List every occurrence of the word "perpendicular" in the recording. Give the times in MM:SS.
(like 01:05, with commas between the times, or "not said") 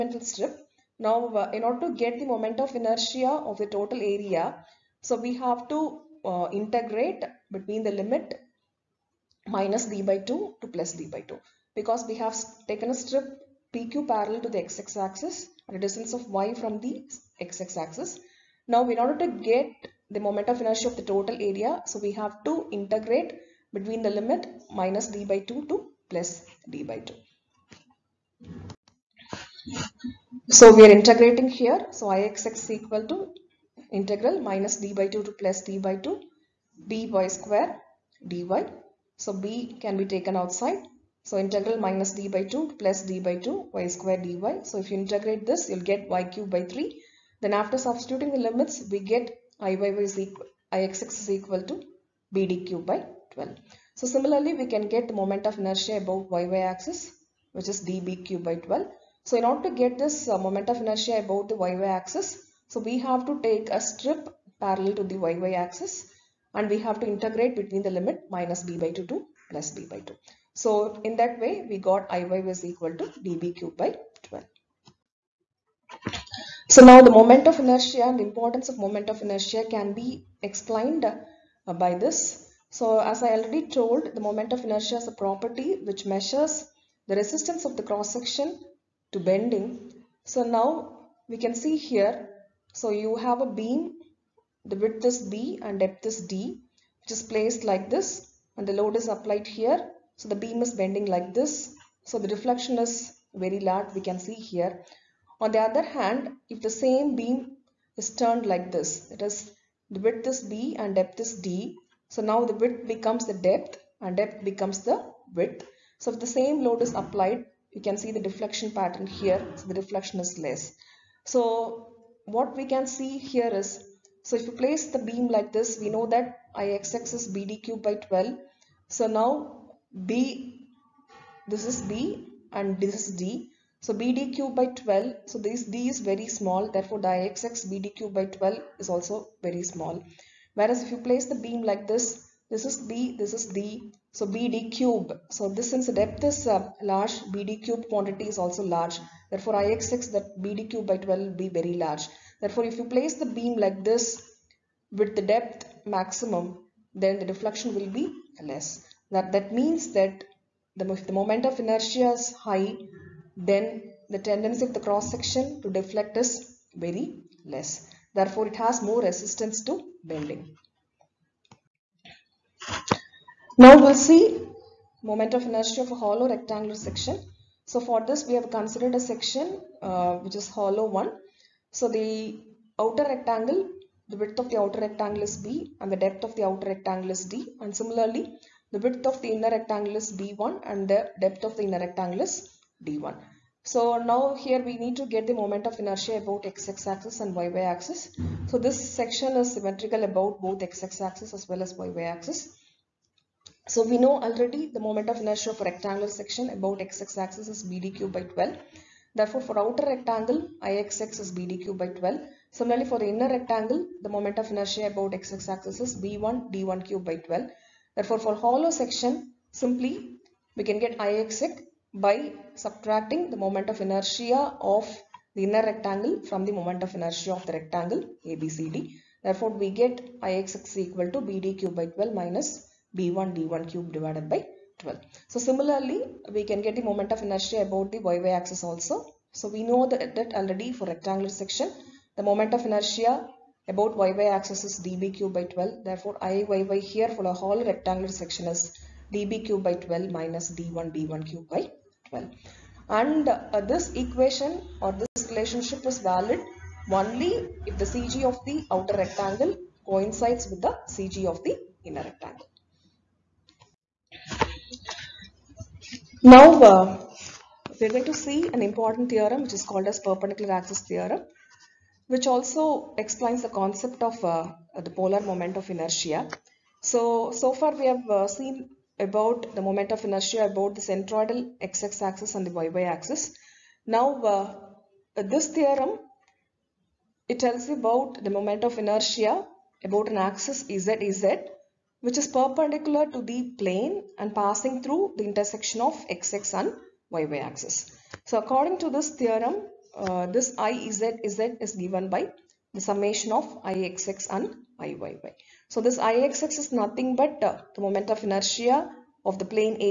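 04:29, 04:52.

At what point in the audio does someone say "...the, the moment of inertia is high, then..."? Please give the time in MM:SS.
02:40.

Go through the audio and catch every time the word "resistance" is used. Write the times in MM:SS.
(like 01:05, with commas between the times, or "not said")
01:27, 02:49.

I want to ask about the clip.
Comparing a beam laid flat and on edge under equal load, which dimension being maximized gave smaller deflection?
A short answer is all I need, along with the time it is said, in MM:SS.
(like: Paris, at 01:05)
depth maximum, at 02:35.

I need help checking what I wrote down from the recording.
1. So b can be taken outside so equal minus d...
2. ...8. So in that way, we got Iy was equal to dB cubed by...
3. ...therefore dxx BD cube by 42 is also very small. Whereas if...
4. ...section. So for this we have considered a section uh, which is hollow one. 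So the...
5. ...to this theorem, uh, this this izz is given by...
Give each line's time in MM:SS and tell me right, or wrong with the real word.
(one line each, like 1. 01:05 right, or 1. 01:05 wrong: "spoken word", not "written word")
1. 00:39 wrong: "integral", not "equal"
2. 01:10 wrong: "2", not "8"
3. 02:16 wrong: "12", not "42"
4. 02:56 right
5. 04:58 right.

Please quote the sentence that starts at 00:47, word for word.
Then after substituting the limits, we get iyy is equal, ixx is equal to bd cube by 12.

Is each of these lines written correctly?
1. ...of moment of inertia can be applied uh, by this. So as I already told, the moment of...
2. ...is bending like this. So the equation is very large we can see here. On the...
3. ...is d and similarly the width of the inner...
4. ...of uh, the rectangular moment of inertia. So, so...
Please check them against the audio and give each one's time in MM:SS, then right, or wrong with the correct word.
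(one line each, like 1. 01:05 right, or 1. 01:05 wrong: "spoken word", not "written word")
1. 01:18 wrong: "explained", not "applied"
2. 01:40 wrong: "deflection", not "equation"
3. 03:07 right
4. 04:34 wrong: "polar", not "rectangular".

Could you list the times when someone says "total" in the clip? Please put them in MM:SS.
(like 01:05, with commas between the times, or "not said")
00:03, 00:21.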